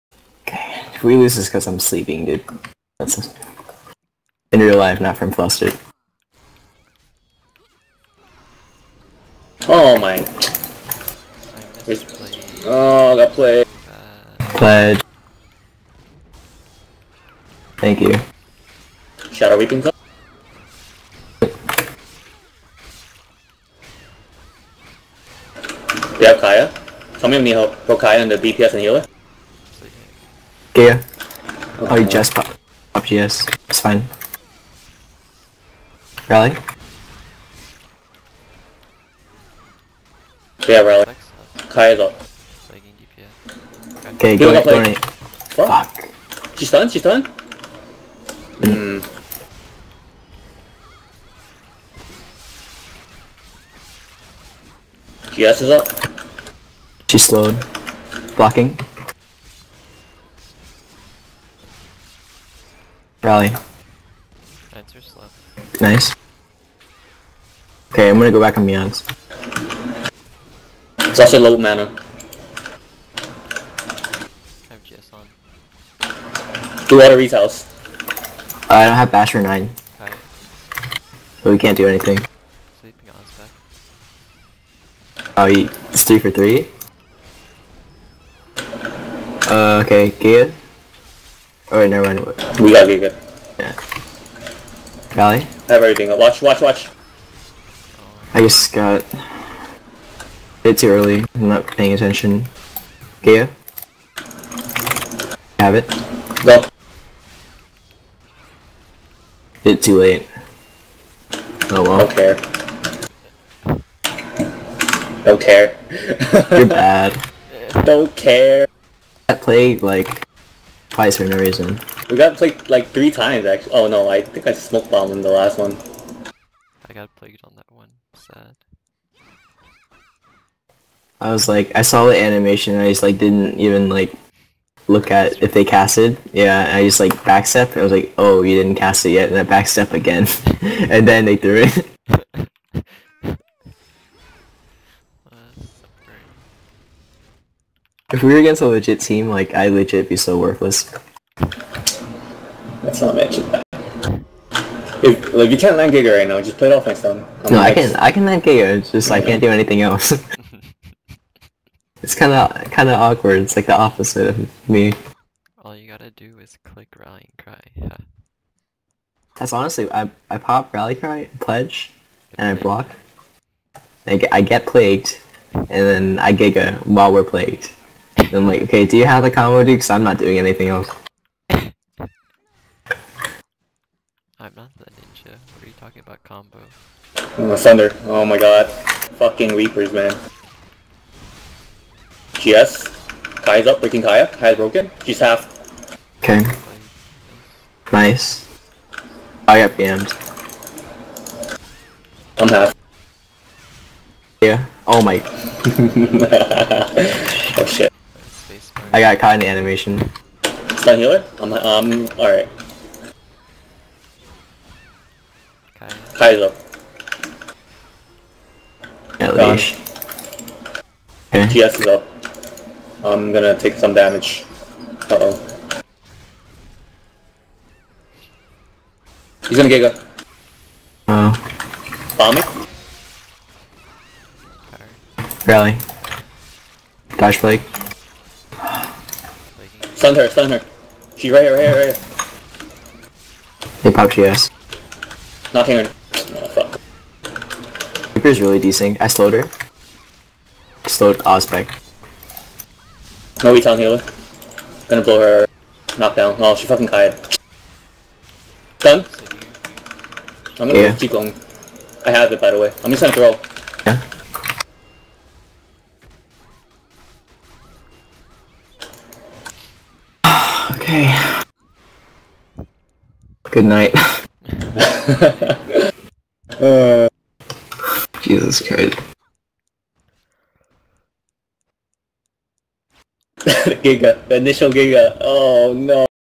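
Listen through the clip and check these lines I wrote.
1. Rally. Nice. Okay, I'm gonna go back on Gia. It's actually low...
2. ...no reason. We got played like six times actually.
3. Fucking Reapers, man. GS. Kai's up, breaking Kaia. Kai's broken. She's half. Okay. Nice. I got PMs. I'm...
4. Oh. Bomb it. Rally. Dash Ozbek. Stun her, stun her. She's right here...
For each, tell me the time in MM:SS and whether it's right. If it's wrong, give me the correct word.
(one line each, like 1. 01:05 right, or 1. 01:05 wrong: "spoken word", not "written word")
1. 01:03 wrong: "Meons", not "Gia"
2. 02:01 wrong: "three", not "six"
3. 03:09 right
4. 03:51 wrong: "Flake", not "Ozbek".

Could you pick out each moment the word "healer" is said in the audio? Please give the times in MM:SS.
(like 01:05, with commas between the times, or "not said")
00:28, 03:30, 04:13.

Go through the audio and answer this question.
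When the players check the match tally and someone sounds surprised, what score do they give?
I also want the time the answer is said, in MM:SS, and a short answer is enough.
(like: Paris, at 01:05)
3 for 3, at 01:26.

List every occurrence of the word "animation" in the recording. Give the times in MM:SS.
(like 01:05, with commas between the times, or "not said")
02:12, 03:29.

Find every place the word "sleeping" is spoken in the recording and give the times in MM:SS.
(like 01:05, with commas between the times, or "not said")
00:01, 01:22.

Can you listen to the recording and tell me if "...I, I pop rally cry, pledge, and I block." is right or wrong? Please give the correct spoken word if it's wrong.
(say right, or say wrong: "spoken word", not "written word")
right.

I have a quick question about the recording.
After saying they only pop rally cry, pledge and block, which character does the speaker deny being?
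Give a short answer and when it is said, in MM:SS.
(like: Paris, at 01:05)
The ninja, at 03:04.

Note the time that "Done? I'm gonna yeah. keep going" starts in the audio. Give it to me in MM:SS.
04:18.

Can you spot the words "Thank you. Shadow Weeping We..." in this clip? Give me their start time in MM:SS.
00:17.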